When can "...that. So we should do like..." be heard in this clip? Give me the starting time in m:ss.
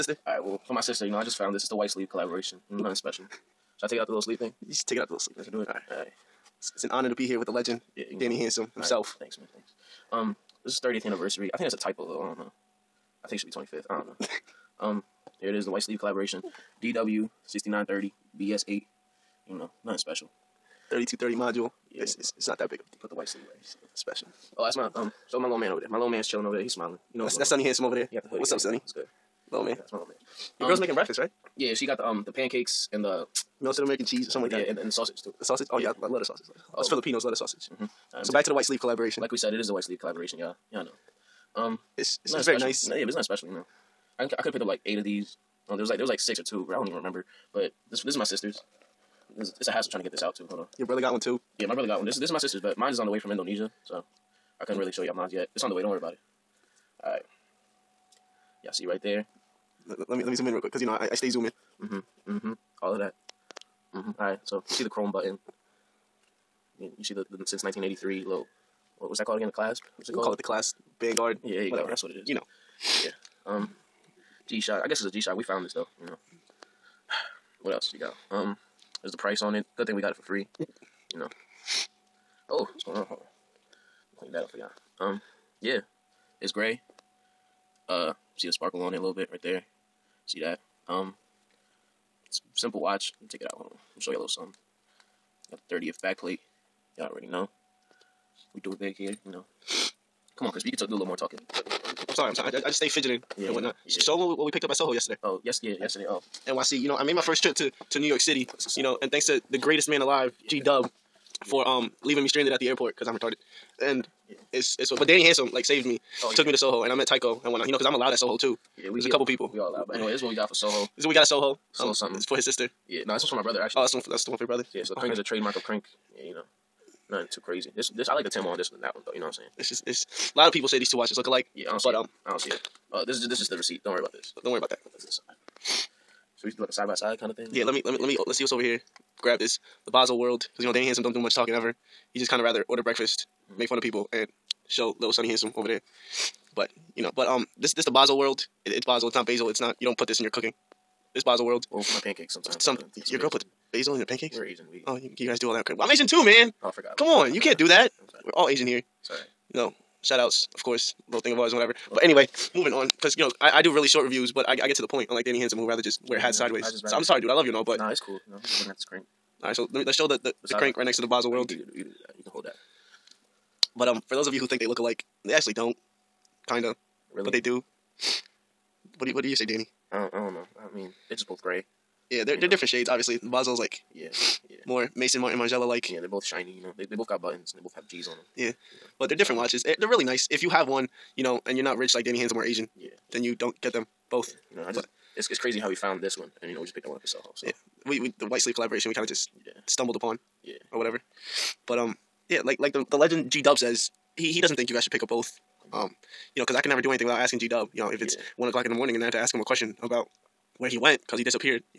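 2:14.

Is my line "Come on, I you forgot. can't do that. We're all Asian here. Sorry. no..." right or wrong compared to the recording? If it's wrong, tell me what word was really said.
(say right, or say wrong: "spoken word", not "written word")
right.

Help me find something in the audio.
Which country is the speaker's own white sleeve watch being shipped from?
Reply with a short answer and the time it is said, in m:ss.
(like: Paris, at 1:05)
Indonesia, at 0:53.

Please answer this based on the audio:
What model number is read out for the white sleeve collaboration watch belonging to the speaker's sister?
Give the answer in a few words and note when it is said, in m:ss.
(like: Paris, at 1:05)
DW6930, at 0:16.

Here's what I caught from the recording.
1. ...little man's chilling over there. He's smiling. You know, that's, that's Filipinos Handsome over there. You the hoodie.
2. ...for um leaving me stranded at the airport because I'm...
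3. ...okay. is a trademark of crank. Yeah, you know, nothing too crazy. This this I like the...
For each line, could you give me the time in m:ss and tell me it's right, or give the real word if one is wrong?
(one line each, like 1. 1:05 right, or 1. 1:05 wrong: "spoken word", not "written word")
1. 0:25 wrong: "Sonny", not "Filipinos"
2. 1:51 right
3. 2:05 right.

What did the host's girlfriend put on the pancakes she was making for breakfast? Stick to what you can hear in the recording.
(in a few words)
melted American cheese.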